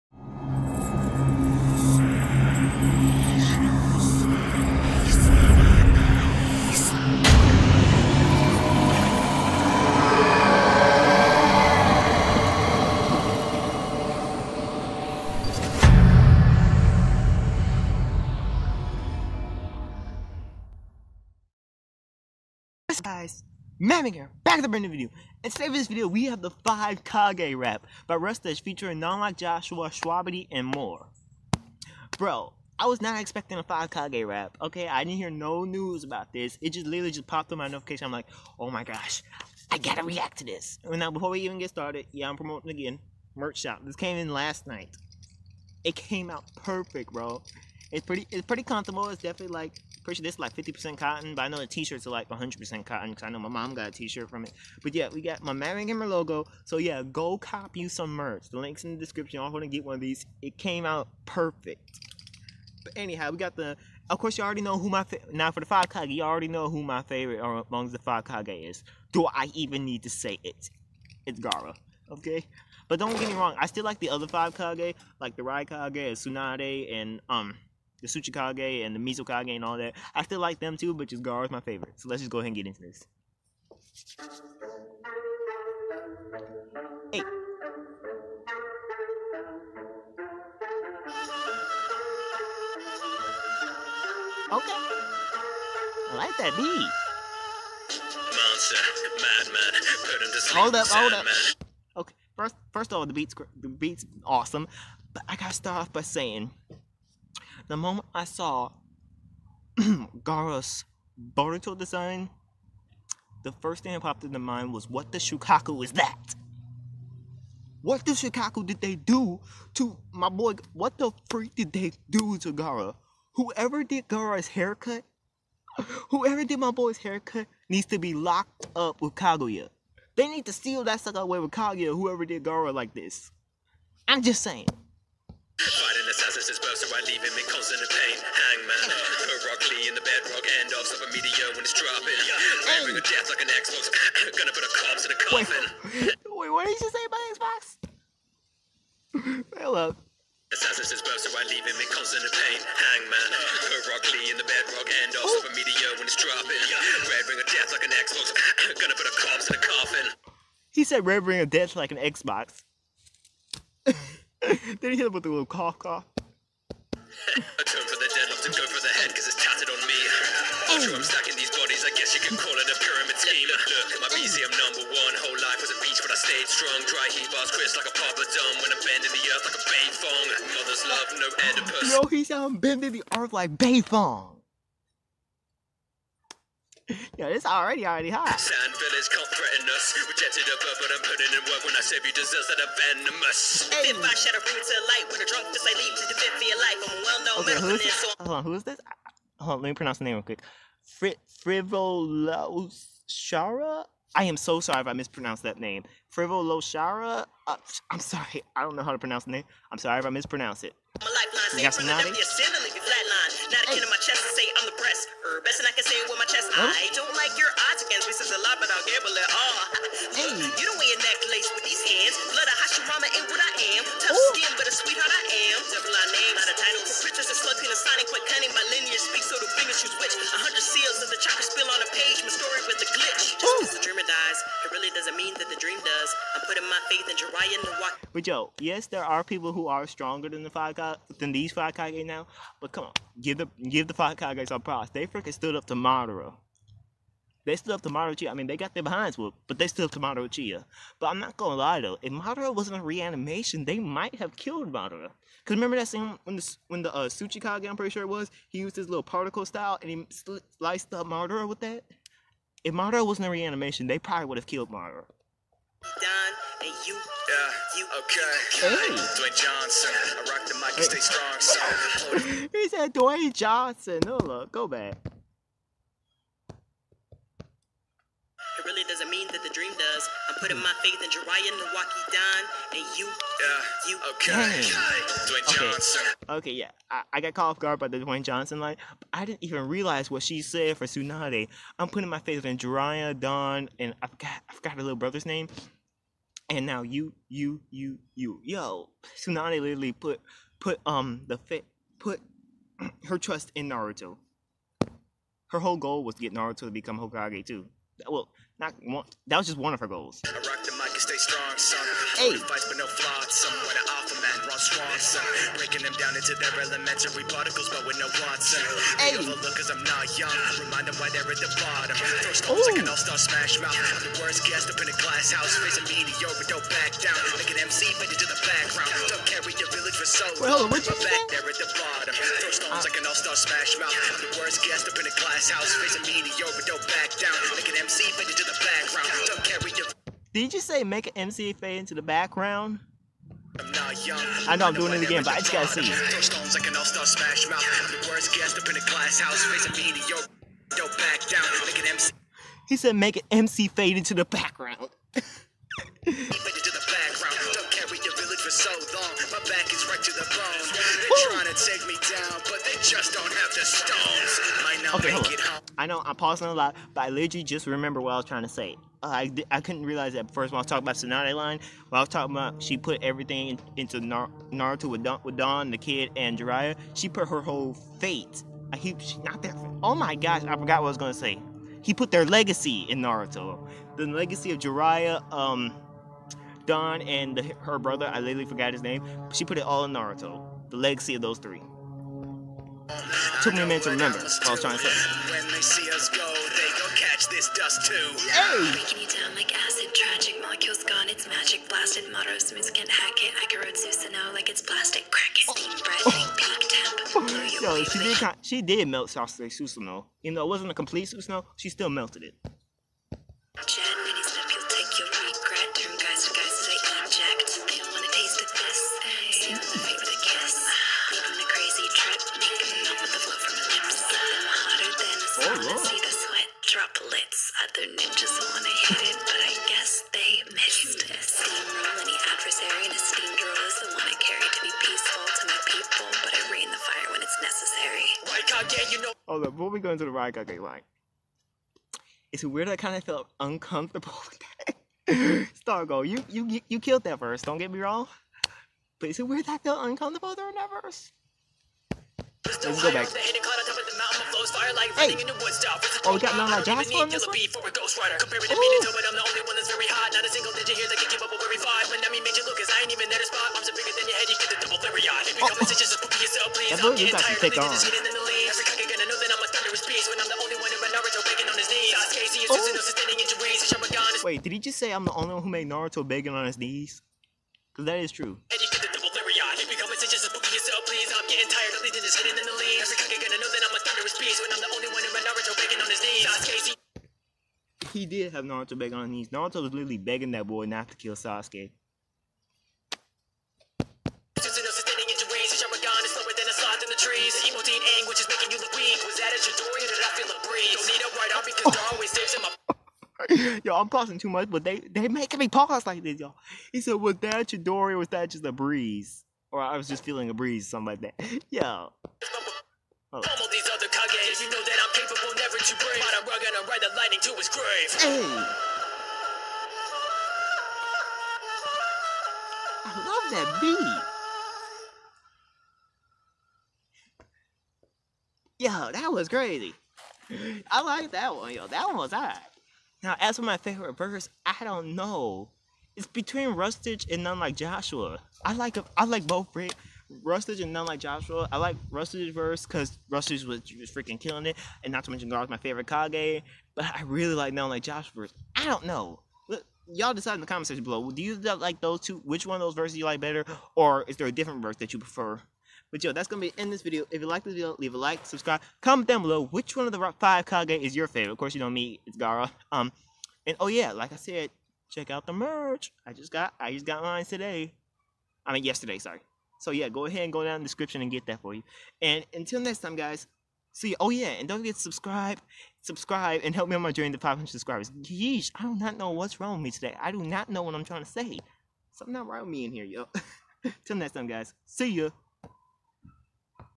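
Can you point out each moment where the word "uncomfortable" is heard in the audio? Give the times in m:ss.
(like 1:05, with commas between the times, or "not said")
7:23, 7:29.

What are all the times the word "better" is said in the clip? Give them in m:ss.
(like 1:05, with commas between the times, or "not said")
9:13.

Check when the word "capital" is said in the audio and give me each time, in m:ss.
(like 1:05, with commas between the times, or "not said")
not said.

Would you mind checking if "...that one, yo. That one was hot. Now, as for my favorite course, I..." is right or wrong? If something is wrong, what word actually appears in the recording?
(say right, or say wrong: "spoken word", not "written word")
wrong: "verse", not "course".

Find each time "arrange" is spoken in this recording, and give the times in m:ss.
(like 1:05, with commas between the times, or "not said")
not said.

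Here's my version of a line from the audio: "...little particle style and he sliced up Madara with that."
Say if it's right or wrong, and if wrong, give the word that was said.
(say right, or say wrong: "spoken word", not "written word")
right.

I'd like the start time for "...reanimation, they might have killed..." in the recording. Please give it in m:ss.
4:12.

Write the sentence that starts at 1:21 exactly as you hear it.
So let's just go ahead and get into this.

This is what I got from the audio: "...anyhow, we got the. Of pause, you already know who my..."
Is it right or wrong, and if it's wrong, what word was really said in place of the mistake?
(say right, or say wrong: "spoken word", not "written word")
wrong: "course", not "pause".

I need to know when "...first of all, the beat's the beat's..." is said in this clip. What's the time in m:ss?
1:42.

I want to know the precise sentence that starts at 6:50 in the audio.
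Even though it wasn't a complete Susanoo, she still melted it.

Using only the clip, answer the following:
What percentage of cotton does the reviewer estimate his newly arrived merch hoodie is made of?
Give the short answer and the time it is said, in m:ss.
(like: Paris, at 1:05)
50%, at 0:50.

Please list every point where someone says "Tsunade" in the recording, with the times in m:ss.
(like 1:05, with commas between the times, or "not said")
1:16, 4:50, 4:59, 6:10.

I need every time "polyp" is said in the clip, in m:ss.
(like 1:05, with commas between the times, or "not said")
not said.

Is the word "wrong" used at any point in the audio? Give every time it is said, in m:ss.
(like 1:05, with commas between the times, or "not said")
1:13, 7:27, 9:39.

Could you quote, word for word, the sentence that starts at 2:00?
What the freak did they do to Gara?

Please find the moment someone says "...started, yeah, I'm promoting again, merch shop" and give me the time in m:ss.
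0:41.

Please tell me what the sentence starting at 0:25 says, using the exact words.
And today for this video, we have the 5 Kage rap by Rustage featuring None Like Joshua, Shwabadi, and more.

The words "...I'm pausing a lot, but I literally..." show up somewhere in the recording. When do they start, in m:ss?
6:06.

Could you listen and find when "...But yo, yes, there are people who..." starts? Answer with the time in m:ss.
3:58.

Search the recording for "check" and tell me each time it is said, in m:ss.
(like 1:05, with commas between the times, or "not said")
9:24.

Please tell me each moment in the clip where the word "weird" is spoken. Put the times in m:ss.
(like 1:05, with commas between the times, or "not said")
7:22, 7:29.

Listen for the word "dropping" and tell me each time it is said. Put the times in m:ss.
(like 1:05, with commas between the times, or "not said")
2:21, 2:36.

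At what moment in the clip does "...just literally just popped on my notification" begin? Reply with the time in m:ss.
0:36.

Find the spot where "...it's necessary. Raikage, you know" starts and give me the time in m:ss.
7:17.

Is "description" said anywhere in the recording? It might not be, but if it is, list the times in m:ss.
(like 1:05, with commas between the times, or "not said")
0:58, 9:30.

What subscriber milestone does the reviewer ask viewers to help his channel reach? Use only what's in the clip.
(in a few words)
500.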